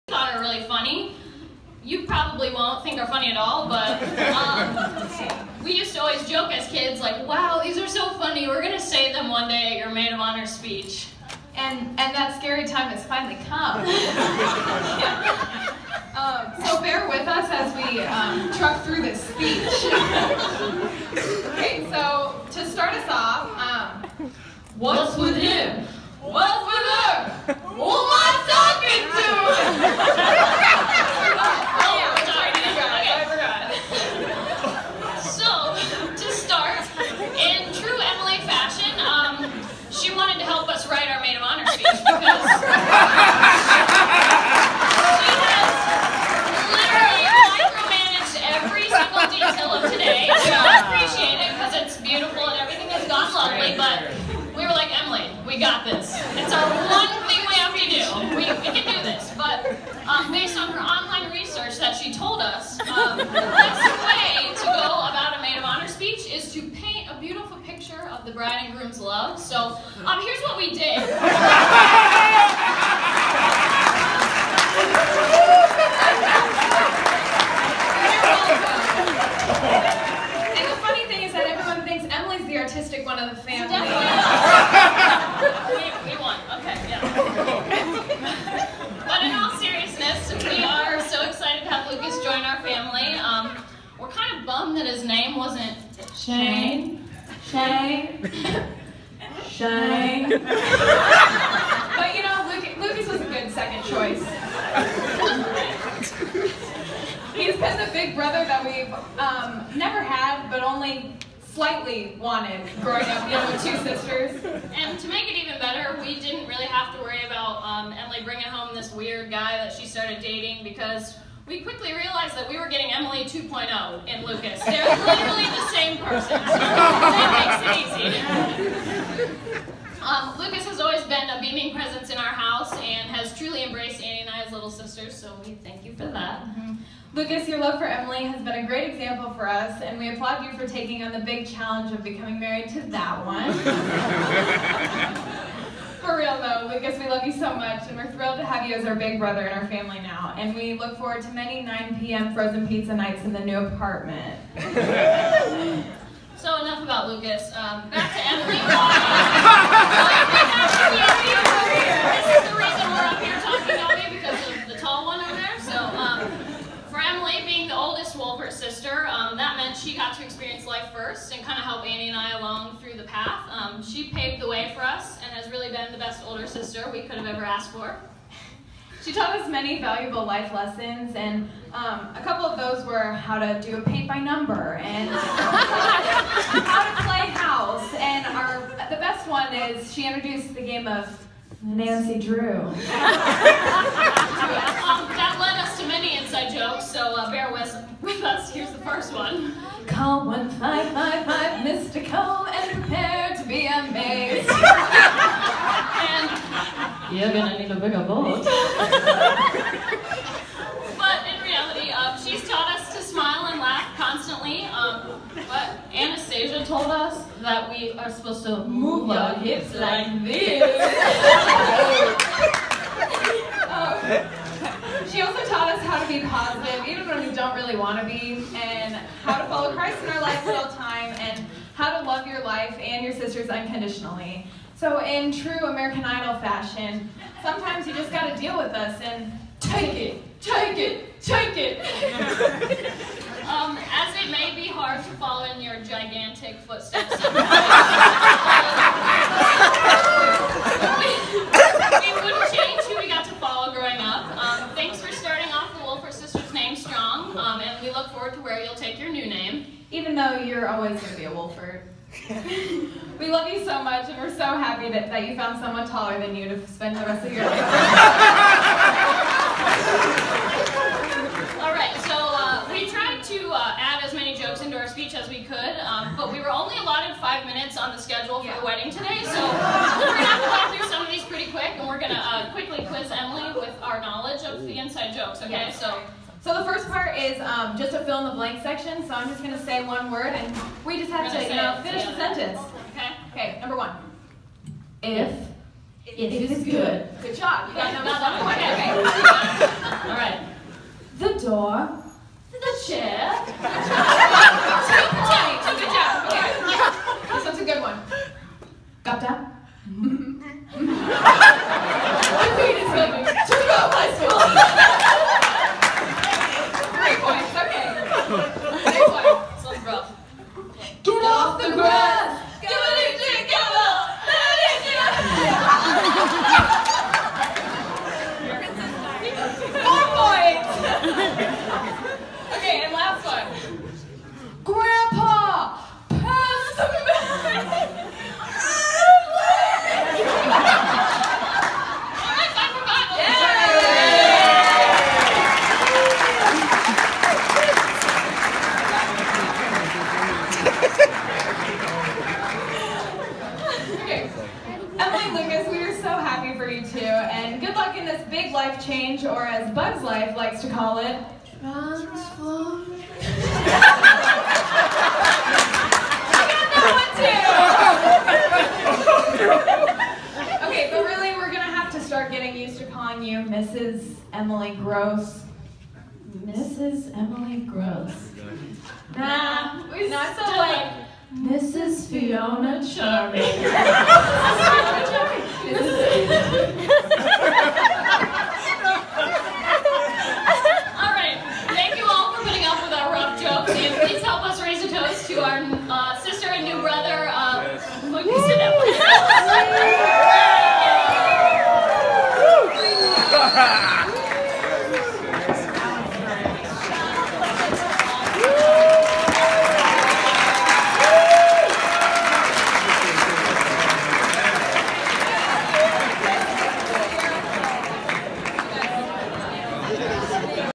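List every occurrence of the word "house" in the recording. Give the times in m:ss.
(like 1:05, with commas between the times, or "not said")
2:12, 3:07.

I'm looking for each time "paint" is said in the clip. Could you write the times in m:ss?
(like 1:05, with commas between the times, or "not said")
1:06, 3:03.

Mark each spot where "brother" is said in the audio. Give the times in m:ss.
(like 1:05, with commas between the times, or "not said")
1:48, 2:29, 6:36.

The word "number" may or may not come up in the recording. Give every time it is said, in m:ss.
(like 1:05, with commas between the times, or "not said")
3:04, 4:53.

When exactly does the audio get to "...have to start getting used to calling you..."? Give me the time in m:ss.
6:11.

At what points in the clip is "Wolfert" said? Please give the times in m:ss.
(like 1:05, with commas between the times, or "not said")
2:48, 4:15, 4:21.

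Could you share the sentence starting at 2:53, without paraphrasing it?
Um, she paved the way for us has really been the best older sister we could have ever asked for.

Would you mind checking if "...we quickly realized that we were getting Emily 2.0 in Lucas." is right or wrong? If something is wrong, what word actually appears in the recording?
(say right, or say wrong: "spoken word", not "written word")
right.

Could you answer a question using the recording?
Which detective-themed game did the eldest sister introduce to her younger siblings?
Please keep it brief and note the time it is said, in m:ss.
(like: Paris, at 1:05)
Nancy Drew, at 3:11.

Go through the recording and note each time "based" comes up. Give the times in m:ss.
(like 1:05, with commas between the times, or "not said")
1:00.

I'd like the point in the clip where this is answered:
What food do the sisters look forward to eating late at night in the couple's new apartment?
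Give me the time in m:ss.
2:32.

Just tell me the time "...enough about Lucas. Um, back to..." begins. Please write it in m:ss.
2:36.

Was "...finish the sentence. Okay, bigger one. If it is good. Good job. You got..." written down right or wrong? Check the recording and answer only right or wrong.
wrong.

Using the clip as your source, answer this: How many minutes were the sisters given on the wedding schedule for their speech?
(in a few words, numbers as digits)
5.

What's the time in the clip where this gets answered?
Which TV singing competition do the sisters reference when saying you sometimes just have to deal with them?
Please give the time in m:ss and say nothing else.
3:55.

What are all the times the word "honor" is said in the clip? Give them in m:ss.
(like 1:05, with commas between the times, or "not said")
0:10, 1:05.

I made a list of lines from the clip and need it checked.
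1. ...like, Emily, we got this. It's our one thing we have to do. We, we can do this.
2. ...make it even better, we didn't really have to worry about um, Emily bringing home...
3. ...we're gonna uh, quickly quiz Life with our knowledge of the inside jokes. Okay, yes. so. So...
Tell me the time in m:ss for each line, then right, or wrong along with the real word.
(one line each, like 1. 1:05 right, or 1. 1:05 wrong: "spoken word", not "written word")
1. 0:54 right
2. 1:55 right
3. 4:41 wrong: "Emily", not "Life".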